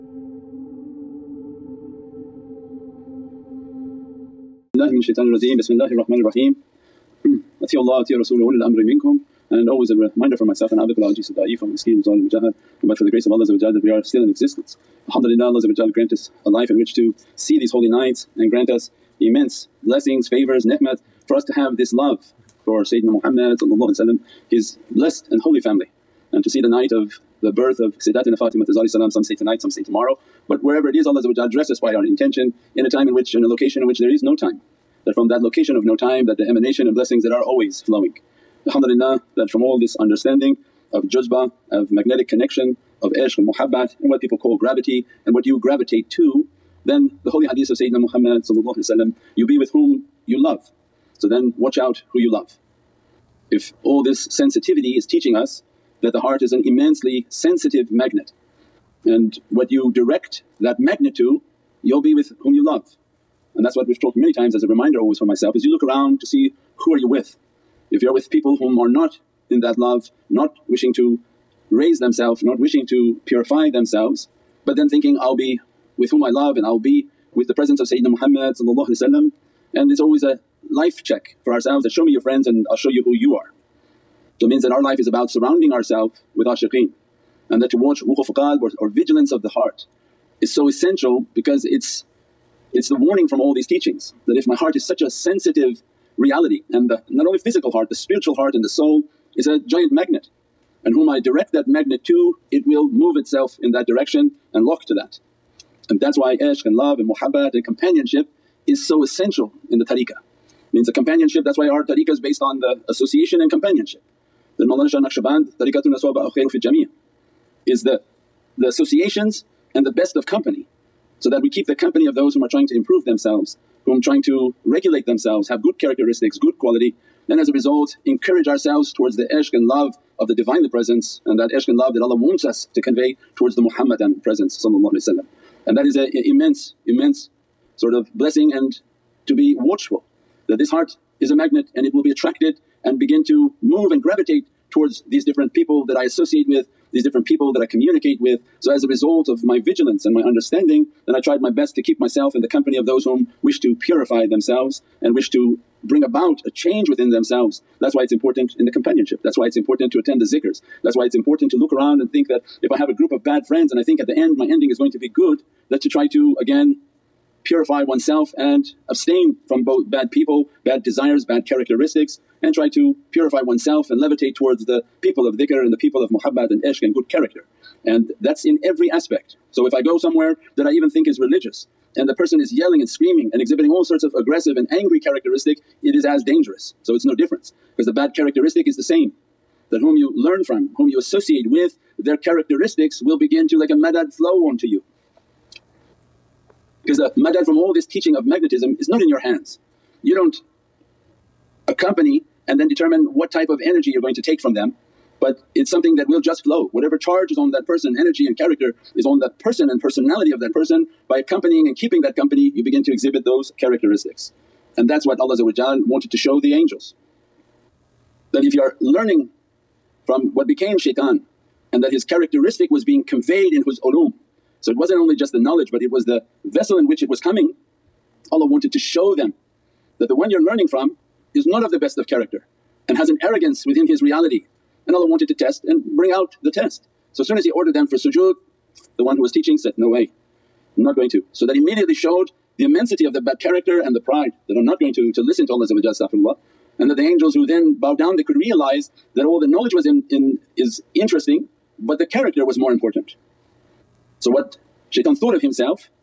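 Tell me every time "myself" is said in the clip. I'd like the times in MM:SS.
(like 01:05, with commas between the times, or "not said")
00:10, 01:05, 02:31.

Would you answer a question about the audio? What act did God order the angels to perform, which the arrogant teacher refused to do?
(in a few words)
sujood.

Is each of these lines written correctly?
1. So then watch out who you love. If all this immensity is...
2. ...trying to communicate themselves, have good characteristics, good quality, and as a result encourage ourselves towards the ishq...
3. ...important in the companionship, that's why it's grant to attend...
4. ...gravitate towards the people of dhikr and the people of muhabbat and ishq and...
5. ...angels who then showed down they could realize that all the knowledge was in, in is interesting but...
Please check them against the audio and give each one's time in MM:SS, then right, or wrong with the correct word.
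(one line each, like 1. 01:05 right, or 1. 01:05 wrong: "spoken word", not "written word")
1. 00:51 wrong: "sensitivity", not "immensity"
2. 02:04 wrong: "regulate", not "communicate"
3. 02:38 wrong: "important", not "grant"
4. 02:54 wrong: "levitate", not "gravitate"
5. 04:07 wrong: "bowed", not "showed".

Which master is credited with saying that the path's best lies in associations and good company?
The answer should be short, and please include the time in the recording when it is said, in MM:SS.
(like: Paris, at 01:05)
Mawlana Shah Naqshband, at 01:54.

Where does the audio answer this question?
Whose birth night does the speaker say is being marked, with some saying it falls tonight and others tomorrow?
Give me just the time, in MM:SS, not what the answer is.
00:27.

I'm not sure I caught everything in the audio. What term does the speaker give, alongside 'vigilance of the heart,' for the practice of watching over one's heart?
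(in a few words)
wuquf qalb.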